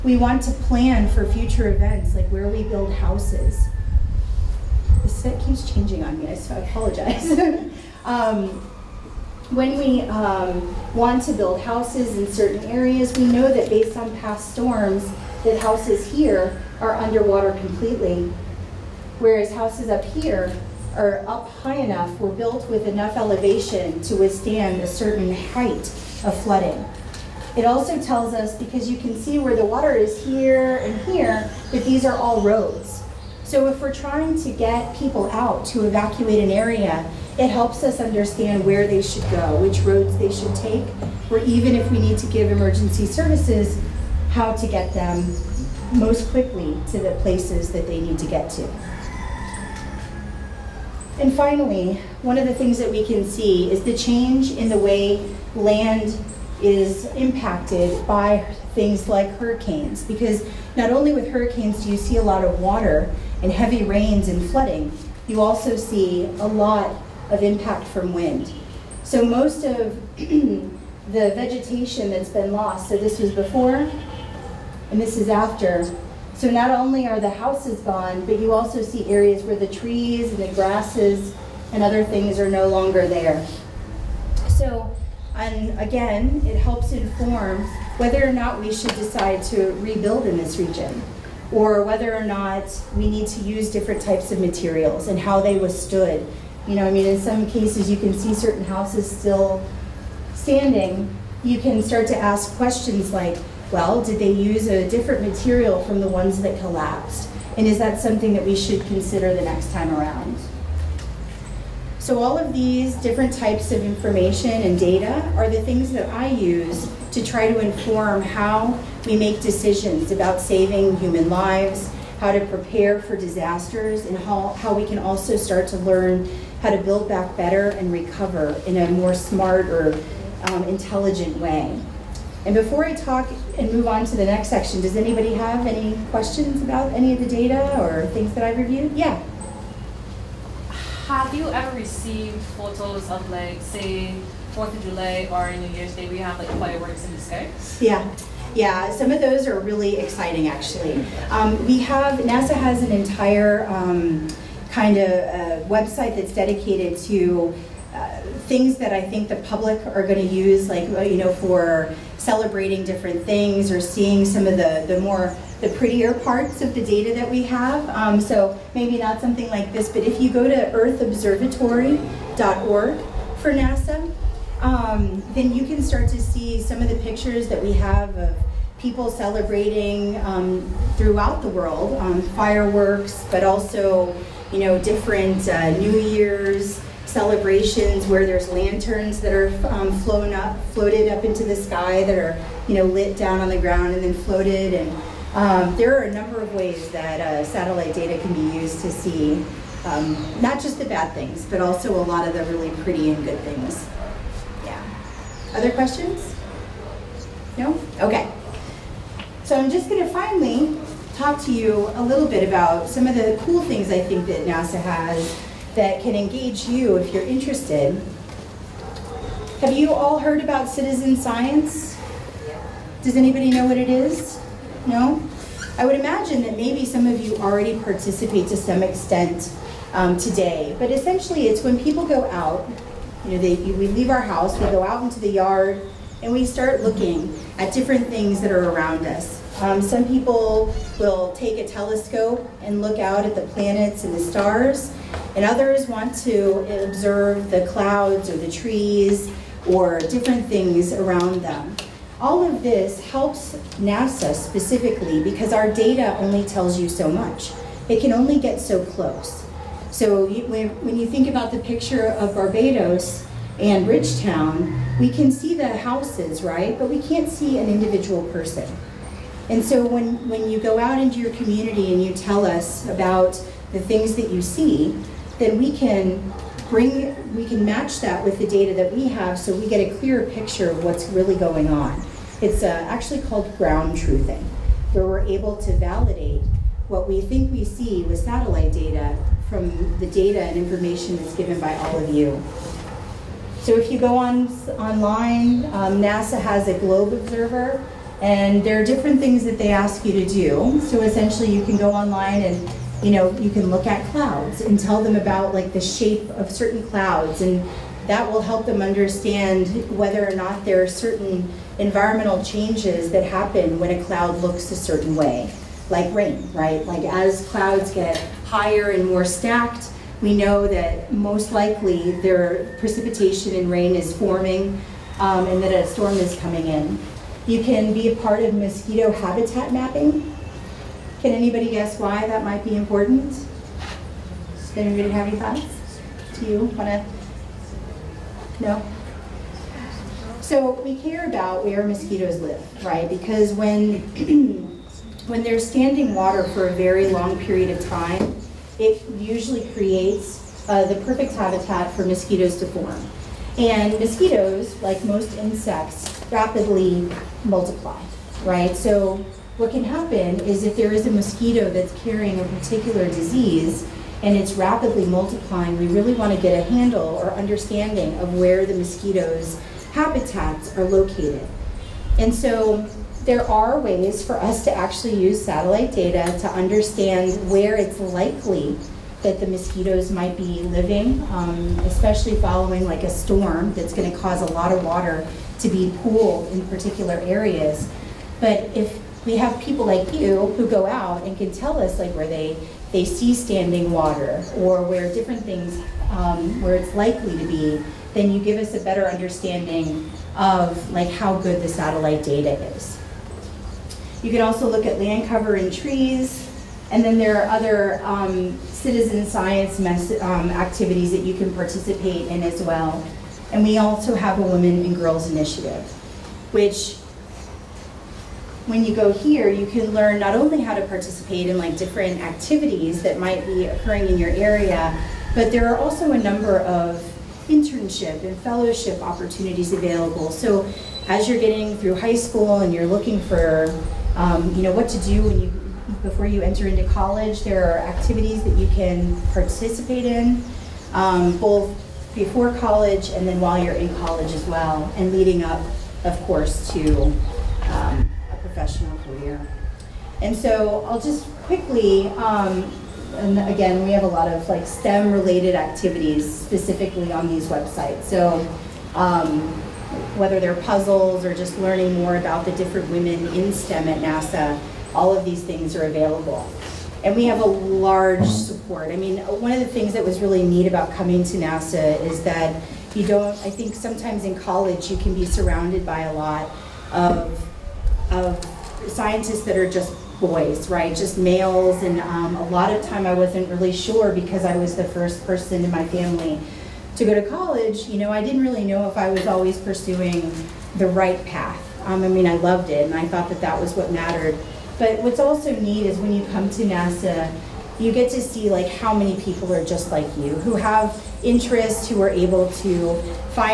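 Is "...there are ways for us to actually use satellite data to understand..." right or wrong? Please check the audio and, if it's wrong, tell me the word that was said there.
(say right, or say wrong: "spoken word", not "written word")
right.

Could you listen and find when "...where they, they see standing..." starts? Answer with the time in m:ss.
6:32.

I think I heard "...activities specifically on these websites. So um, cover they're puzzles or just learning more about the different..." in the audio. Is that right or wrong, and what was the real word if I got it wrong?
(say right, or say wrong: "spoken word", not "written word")
wrong: "whether", not "cover".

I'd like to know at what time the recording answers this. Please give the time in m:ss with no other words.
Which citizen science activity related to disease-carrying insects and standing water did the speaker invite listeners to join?
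5:28.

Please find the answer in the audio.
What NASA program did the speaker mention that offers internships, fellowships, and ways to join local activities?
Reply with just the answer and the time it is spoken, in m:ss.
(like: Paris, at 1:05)
Women and Girls Initiative, at 6:54.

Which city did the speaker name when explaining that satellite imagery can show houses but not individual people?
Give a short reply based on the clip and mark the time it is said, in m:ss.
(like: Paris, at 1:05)
Bridgetown, at 4:23.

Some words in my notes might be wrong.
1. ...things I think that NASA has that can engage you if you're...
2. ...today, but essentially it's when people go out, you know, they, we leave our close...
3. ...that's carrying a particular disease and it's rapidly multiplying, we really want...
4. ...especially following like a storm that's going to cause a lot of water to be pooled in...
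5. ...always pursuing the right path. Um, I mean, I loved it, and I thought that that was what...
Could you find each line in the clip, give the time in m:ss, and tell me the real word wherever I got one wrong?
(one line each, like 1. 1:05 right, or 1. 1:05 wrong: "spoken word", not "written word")
1. 3:33 right
2. 3:50 wrong: "house", not "close"
3. 6:01 right
4. 6:21 right
5. 8:09 right.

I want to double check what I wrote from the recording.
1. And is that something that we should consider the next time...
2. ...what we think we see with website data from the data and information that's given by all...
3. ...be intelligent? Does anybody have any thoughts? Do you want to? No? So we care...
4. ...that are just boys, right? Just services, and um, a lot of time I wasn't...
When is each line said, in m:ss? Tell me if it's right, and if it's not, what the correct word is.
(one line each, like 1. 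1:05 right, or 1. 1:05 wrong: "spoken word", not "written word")
1. 1:47 right
2. 4:46 wrong: "satellite", not "website"
3. 5:32 wrong: "important", not "intelligent"
4. 7:59 wrong: "males", not "services".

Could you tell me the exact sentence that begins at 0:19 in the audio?
Whereas houses up here are up high enough, were built with enough elevation to withstand a certain height of flooding.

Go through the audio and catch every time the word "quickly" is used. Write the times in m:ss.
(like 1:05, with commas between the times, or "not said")
0:46, 7:31.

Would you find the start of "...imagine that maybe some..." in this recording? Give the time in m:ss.
3:45.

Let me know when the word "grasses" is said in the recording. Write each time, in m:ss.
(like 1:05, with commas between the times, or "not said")
1:20.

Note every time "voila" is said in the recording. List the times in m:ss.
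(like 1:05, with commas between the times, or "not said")
not said.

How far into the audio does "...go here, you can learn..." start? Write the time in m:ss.
6:58.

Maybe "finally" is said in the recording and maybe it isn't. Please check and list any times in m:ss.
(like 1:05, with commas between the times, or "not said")
0:51, 3:30.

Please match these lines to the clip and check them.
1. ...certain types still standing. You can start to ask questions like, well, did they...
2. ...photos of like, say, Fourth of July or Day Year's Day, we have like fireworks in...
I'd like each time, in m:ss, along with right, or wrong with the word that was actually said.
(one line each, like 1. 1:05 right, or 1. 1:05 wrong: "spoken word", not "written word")
1. 1:38 wrong: "houses", not "types"
2. 2:22 wrong: "New", not "Day".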